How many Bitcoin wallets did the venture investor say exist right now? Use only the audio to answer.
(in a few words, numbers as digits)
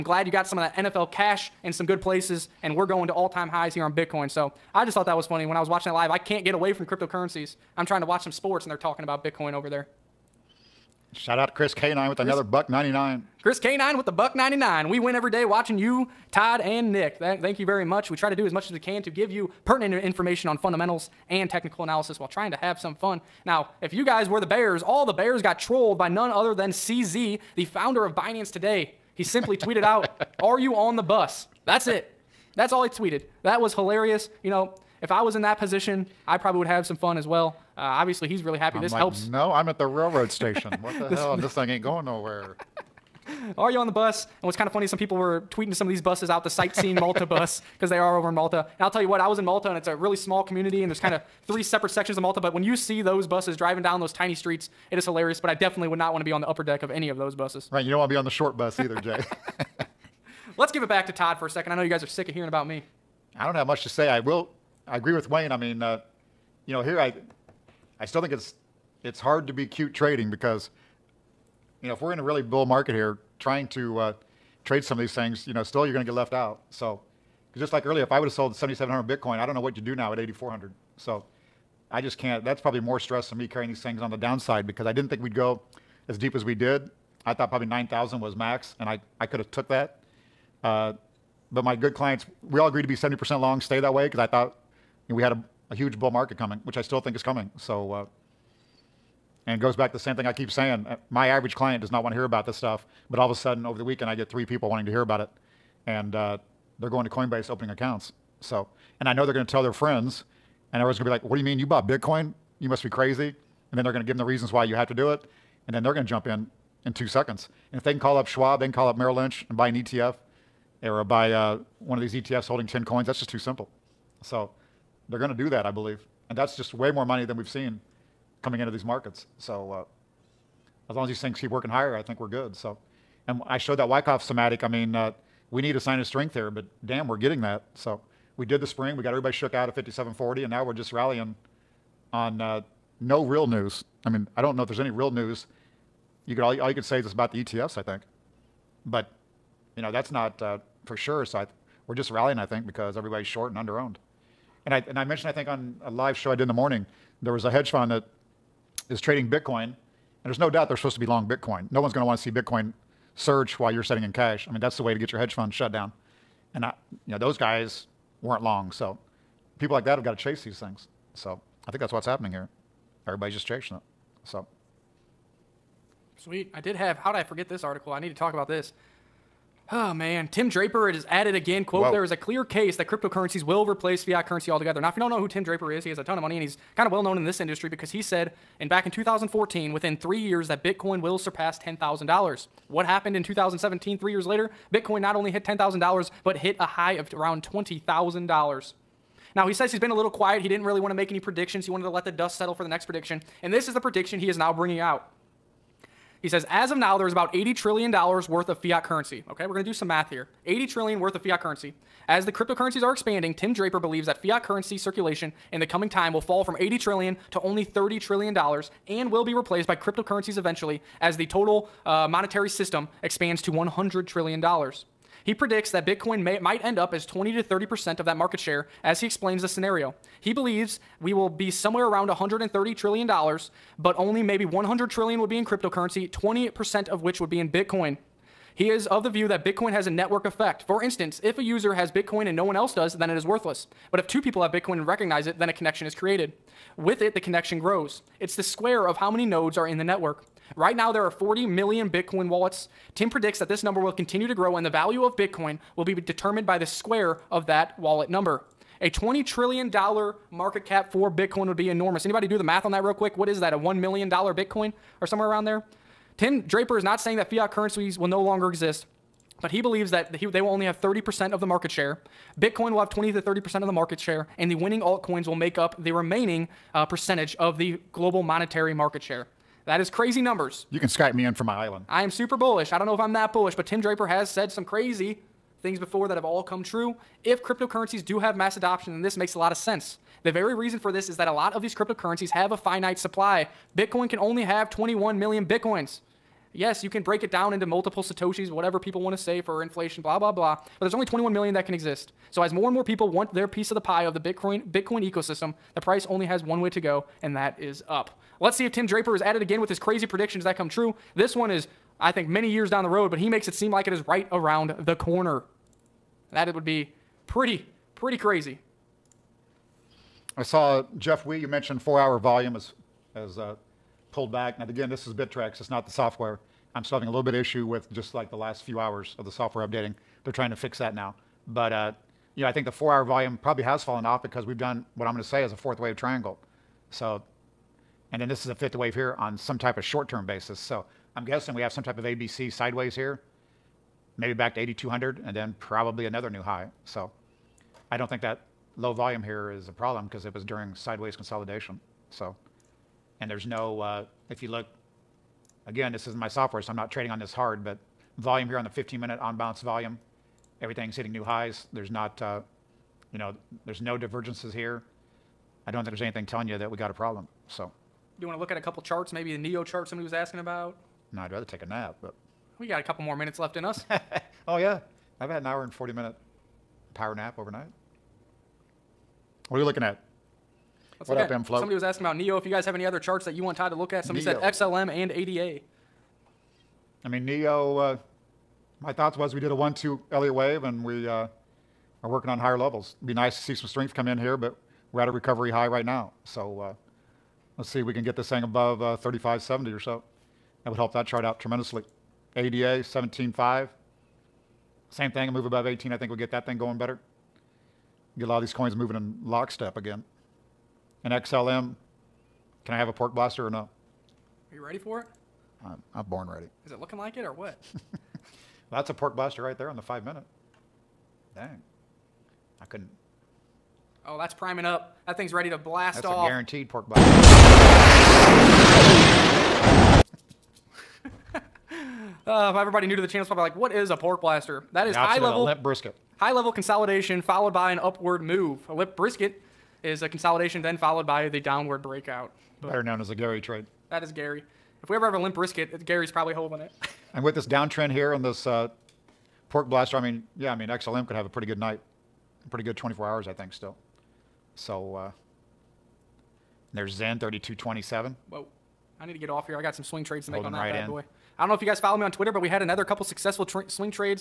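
40 million.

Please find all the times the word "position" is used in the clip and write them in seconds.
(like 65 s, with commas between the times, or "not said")
35 s.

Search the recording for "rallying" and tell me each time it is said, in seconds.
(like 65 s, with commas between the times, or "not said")
140 s, 152 s.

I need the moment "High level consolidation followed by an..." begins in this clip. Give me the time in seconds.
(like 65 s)
436 s.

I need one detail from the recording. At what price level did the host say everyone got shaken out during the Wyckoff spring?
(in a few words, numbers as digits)
5740.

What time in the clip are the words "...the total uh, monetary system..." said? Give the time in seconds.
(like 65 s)
221 s.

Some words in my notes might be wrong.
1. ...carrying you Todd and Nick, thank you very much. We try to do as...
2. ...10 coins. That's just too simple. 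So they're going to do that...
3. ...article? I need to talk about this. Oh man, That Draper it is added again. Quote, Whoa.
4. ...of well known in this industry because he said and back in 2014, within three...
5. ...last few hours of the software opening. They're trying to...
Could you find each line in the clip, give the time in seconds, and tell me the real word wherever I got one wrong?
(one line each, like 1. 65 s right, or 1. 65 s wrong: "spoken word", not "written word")
1. 15 s wrong: "watching", not "carrying"
2. 122 s right
3. 177 s wrong: "Tim", not "That"
4. 186 s right
5. 328 s wrong: "updating", not "opening".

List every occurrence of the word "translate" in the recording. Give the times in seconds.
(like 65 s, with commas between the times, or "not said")
not said.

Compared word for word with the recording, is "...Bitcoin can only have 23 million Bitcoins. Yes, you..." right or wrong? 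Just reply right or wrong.
wrong.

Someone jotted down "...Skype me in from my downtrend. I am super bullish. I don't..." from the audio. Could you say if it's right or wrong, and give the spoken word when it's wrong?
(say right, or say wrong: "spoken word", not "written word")
wrong: "island", not "downtrend".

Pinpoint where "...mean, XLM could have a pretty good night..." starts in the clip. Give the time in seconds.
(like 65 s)
450 s.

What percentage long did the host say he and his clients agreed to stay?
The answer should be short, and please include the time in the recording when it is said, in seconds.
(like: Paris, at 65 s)
70%, at 92 s.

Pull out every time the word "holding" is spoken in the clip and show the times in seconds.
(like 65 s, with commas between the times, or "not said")
122 s, 446 s, 460 s.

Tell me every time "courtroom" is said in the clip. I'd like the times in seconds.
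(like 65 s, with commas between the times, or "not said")
not said.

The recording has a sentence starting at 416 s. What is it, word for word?
Is it looking like it or what?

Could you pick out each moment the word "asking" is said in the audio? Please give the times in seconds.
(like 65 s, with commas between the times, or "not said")
370 s, 381 s.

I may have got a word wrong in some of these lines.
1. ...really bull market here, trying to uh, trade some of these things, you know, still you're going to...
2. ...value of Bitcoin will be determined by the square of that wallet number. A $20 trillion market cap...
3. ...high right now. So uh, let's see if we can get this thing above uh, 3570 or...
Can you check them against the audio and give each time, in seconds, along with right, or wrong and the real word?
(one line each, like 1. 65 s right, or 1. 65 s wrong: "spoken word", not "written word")
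1. 72 s right
2. 254 s right
3. 395 s right.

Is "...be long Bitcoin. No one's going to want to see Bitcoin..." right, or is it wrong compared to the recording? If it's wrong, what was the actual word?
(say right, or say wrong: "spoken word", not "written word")
right.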